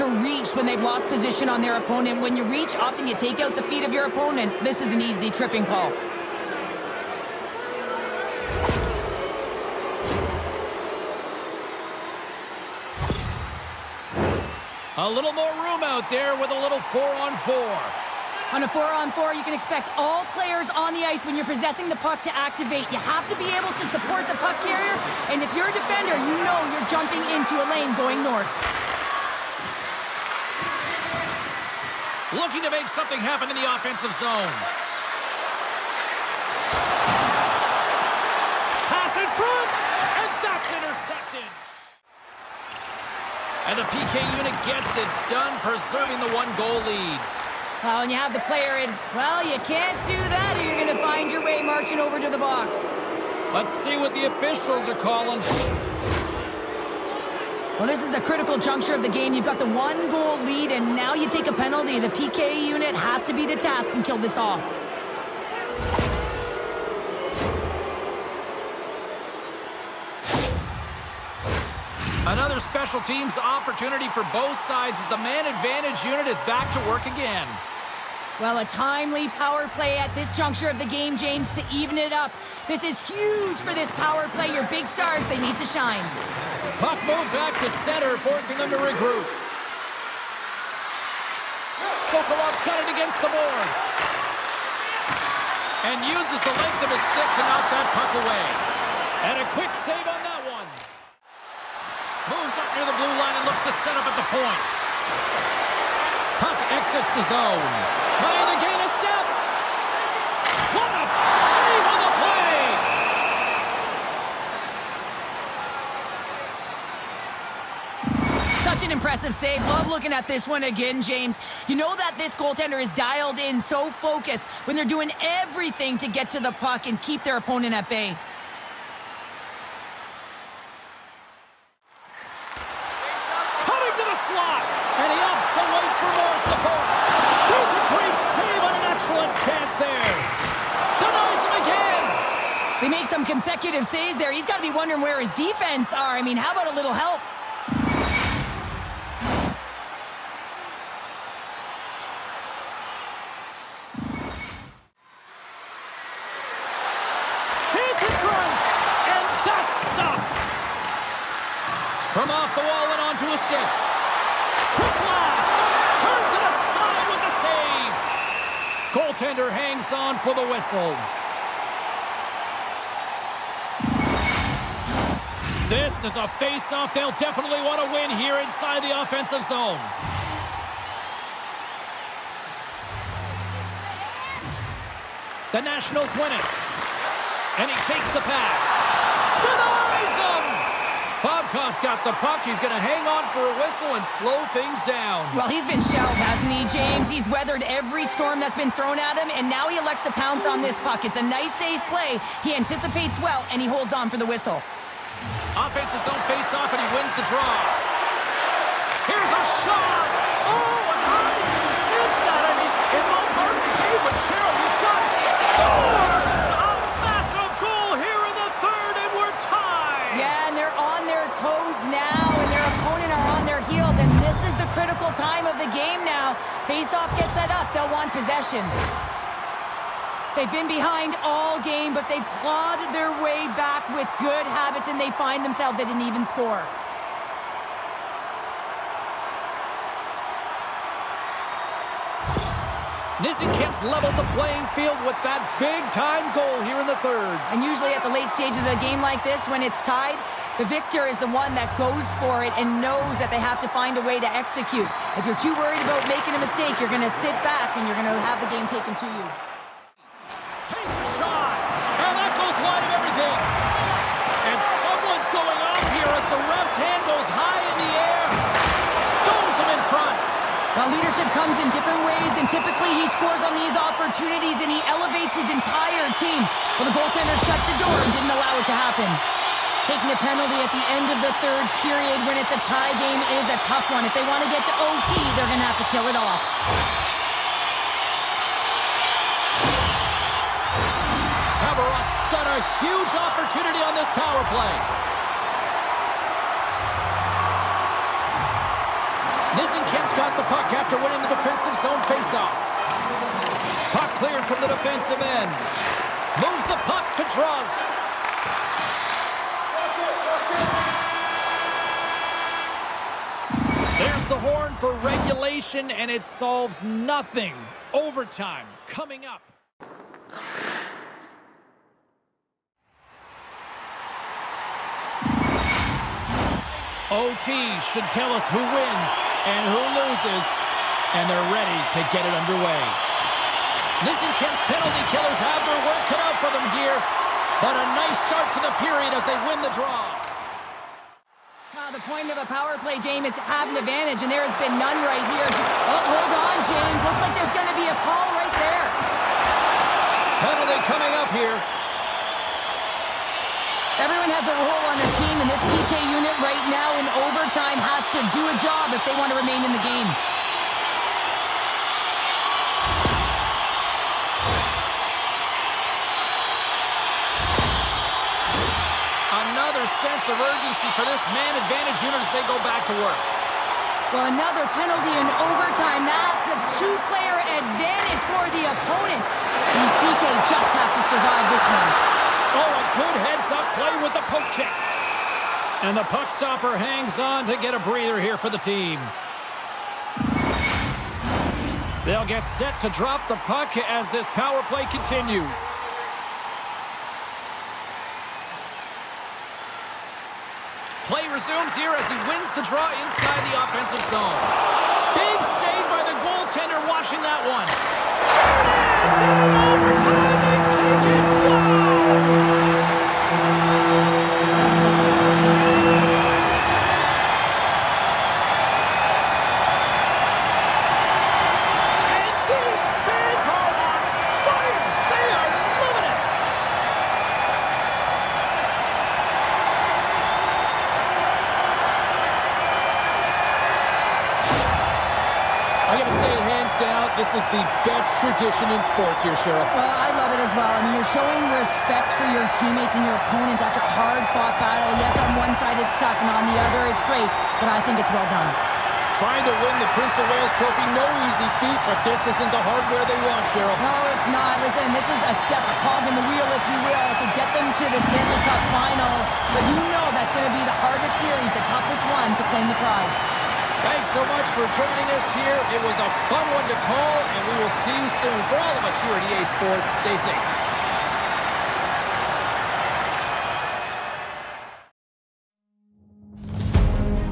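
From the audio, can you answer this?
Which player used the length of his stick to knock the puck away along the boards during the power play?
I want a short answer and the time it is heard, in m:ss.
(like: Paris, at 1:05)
Sokolov, at 1:32.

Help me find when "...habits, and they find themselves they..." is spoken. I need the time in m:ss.
3:54.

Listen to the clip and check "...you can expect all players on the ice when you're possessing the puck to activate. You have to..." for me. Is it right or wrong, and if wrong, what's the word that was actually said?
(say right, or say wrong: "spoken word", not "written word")
right.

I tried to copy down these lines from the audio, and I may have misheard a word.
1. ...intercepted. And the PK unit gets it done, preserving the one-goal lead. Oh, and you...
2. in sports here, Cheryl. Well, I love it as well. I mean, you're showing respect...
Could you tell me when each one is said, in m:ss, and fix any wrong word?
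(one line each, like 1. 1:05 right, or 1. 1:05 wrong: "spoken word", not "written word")
1. 0:40 right
2. 7:18 right.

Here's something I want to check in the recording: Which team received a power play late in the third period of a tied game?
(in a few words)
Khabarovsk.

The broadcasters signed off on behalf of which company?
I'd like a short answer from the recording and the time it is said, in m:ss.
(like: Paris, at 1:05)
EA Sports, at 7:49.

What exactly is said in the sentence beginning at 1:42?
Moves up near the blue line and looks to set up at the point.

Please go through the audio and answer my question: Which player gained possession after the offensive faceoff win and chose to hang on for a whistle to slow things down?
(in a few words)
Stamkos.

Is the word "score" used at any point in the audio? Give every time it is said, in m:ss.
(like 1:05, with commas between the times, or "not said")
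3:56, 4:33.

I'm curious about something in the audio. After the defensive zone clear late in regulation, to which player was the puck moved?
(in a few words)
Drozd.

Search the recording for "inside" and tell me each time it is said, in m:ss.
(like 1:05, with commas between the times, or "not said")
2:58, 6:43.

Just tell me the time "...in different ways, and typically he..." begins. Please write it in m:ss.
4:31.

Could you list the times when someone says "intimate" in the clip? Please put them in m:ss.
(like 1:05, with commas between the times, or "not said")
not said.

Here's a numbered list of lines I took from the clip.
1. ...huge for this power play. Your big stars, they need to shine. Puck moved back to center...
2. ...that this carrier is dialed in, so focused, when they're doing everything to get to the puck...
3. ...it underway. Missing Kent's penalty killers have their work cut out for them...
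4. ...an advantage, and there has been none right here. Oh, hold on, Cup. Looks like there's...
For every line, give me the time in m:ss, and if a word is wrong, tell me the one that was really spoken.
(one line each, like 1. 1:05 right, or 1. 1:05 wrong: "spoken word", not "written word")
1. 1:23 right
2. 2:01 wrong: "goaltender", not "carrier"
3. 5:32 right
4. 5:43 wrong: "James", not "Cup".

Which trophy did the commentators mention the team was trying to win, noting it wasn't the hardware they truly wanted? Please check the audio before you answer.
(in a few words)
Prince of Wales Trophy.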